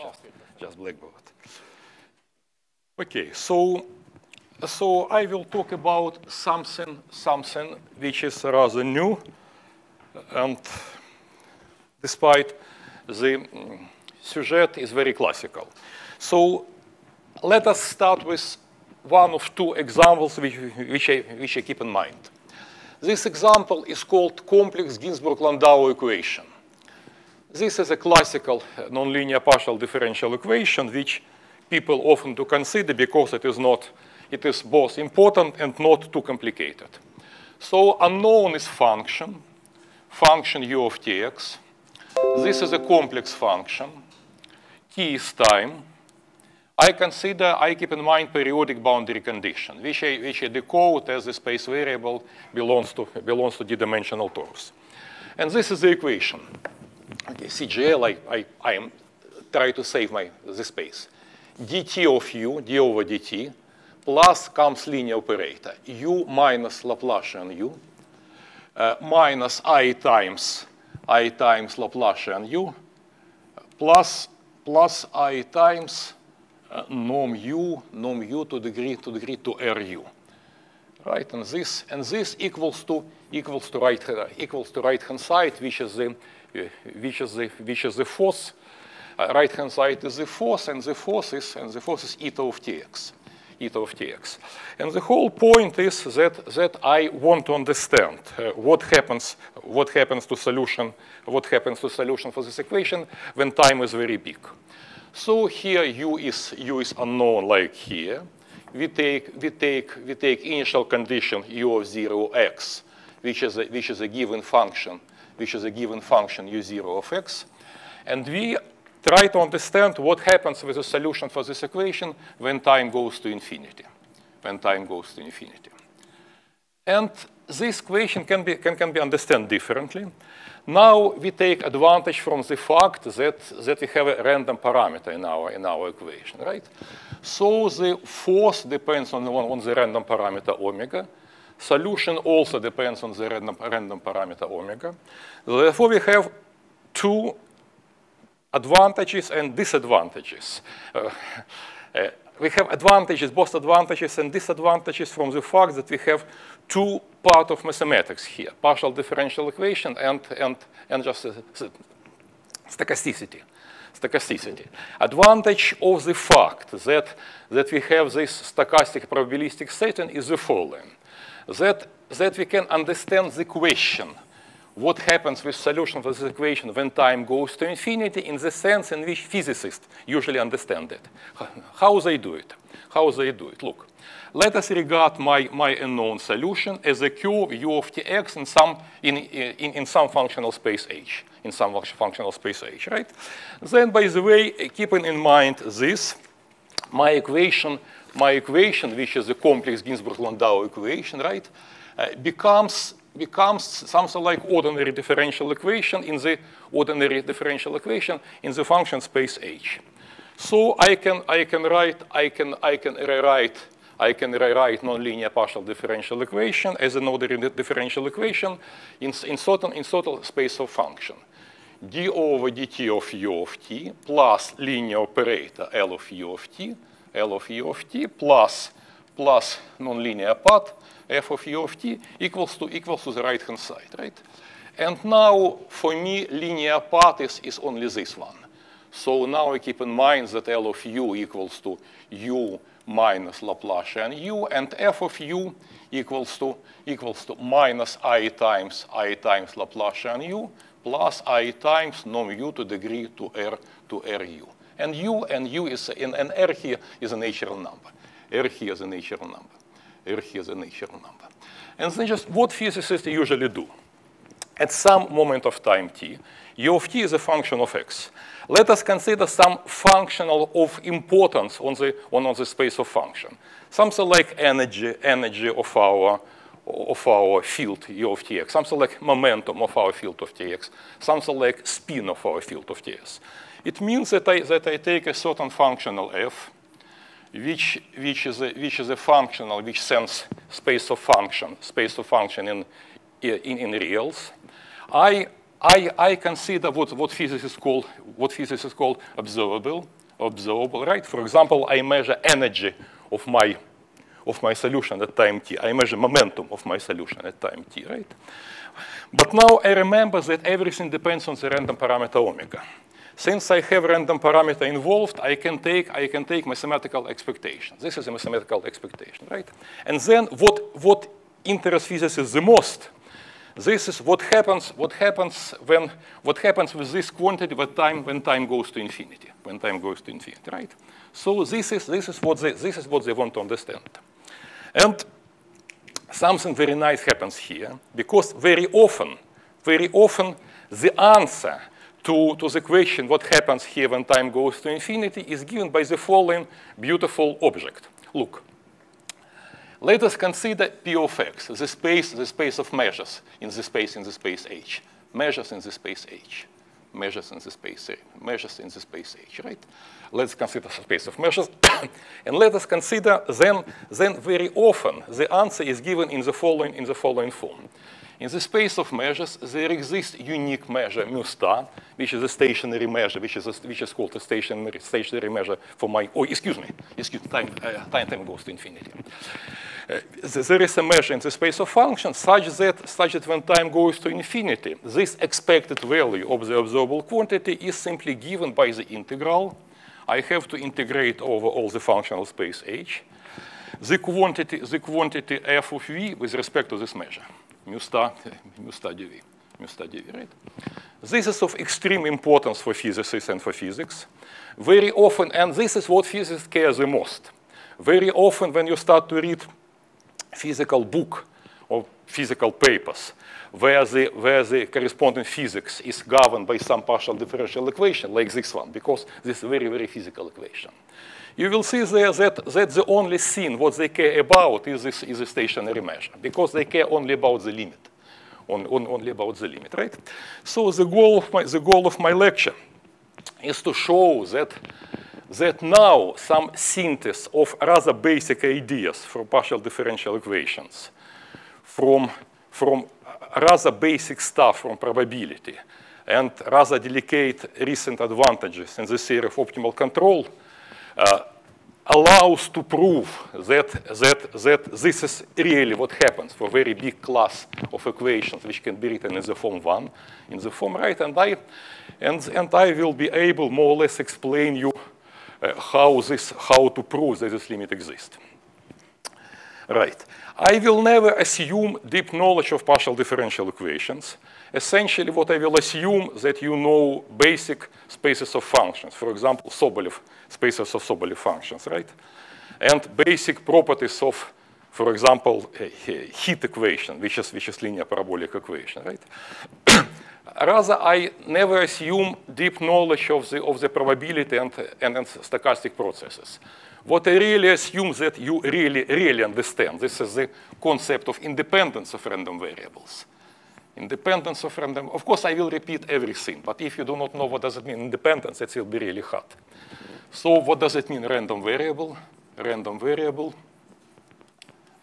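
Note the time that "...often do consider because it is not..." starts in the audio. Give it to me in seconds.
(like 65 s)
32 s.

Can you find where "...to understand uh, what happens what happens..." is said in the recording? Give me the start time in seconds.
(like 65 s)
97 s.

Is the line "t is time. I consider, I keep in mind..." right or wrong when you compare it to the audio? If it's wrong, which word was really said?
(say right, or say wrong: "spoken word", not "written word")
right.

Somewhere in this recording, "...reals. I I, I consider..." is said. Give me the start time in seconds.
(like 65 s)
293 s.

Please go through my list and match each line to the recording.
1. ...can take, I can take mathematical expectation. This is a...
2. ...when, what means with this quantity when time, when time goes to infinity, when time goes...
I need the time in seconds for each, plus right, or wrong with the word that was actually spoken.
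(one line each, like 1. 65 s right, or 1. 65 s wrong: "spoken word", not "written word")
1. 315 s right
2. 325 s wrong: "happens", not "means".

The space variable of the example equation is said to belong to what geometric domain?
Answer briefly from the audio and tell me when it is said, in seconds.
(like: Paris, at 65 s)
d-dimensional torus, at 53 s.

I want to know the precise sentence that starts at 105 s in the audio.
So here u is u is unknown like here.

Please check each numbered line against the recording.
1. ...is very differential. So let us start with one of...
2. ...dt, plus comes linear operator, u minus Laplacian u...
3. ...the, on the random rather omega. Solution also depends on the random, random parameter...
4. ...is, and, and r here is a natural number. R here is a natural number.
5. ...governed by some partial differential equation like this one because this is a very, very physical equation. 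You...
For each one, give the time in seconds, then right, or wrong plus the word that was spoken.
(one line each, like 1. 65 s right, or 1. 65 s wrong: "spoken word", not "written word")
1. 14 s wrong: "classical", not "differential"
2. 63 s right
3. 139 s wrong: "parameter", not "rather"
4. 255 s right
5. 416 s right.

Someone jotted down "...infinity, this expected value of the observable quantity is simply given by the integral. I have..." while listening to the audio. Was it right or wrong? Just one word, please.
right.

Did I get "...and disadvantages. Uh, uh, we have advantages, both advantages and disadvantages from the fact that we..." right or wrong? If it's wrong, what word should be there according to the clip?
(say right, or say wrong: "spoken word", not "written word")
right.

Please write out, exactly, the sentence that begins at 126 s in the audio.
And this equation can be, can, can be understood differently.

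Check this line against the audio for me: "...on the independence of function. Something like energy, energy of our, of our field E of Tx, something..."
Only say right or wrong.
wrong.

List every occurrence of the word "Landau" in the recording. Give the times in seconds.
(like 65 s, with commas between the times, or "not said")
24 s, 199 s.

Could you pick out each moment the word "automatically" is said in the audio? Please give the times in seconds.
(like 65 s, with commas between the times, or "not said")
not said.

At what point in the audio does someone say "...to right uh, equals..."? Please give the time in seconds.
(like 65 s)
83 s.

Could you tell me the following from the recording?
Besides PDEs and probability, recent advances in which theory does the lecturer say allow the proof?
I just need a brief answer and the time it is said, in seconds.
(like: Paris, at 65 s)
Optimal control, at 449 s.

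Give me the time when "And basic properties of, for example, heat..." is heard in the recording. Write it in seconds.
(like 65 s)
482 s.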